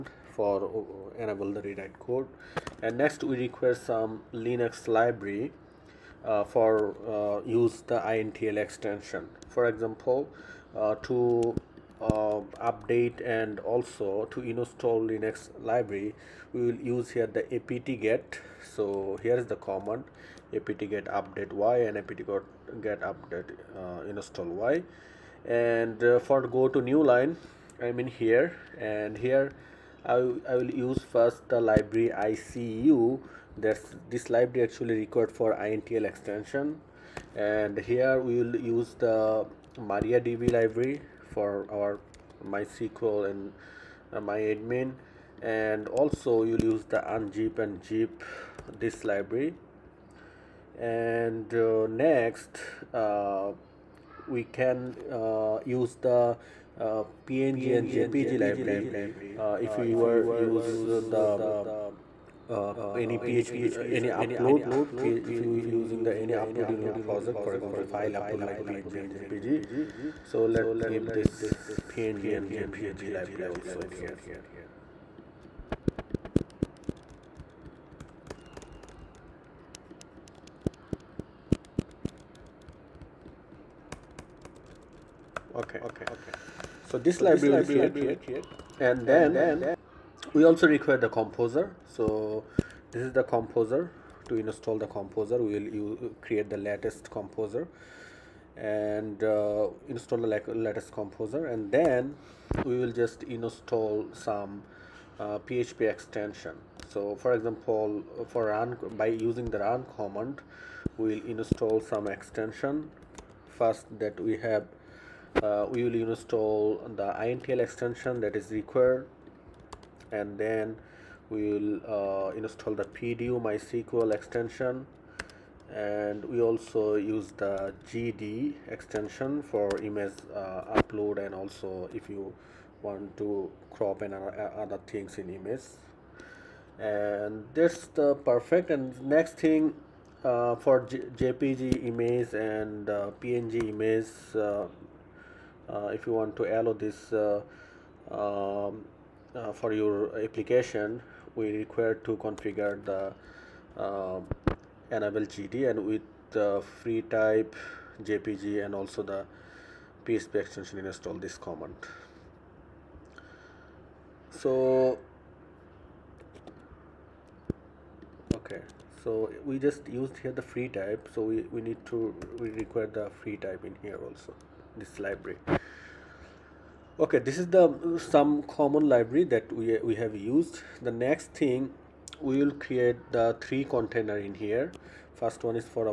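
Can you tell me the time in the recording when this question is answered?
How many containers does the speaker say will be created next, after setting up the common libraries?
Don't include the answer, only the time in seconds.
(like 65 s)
183 s.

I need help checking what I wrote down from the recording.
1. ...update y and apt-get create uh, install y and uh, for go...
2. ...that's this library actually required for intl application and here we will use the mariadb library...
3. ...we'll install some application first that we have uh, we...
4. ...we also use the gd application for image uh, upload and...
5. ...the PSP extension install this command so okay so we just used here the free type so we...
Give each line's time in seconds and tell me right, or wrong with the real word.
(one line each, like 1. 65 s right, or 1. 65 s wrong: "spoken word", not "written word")
1. 21 s wrong: "update", not "create"
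2. 33 s wrong: "extension", not "application"
3. 110 s wrong: "extension", not "application"
4. 126 s wrong: "extension", not "application"
5. 159 s right.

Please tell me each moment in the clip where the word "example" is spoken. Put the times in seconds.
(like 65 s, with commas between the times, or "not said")
9 s, 67 s, 107 s.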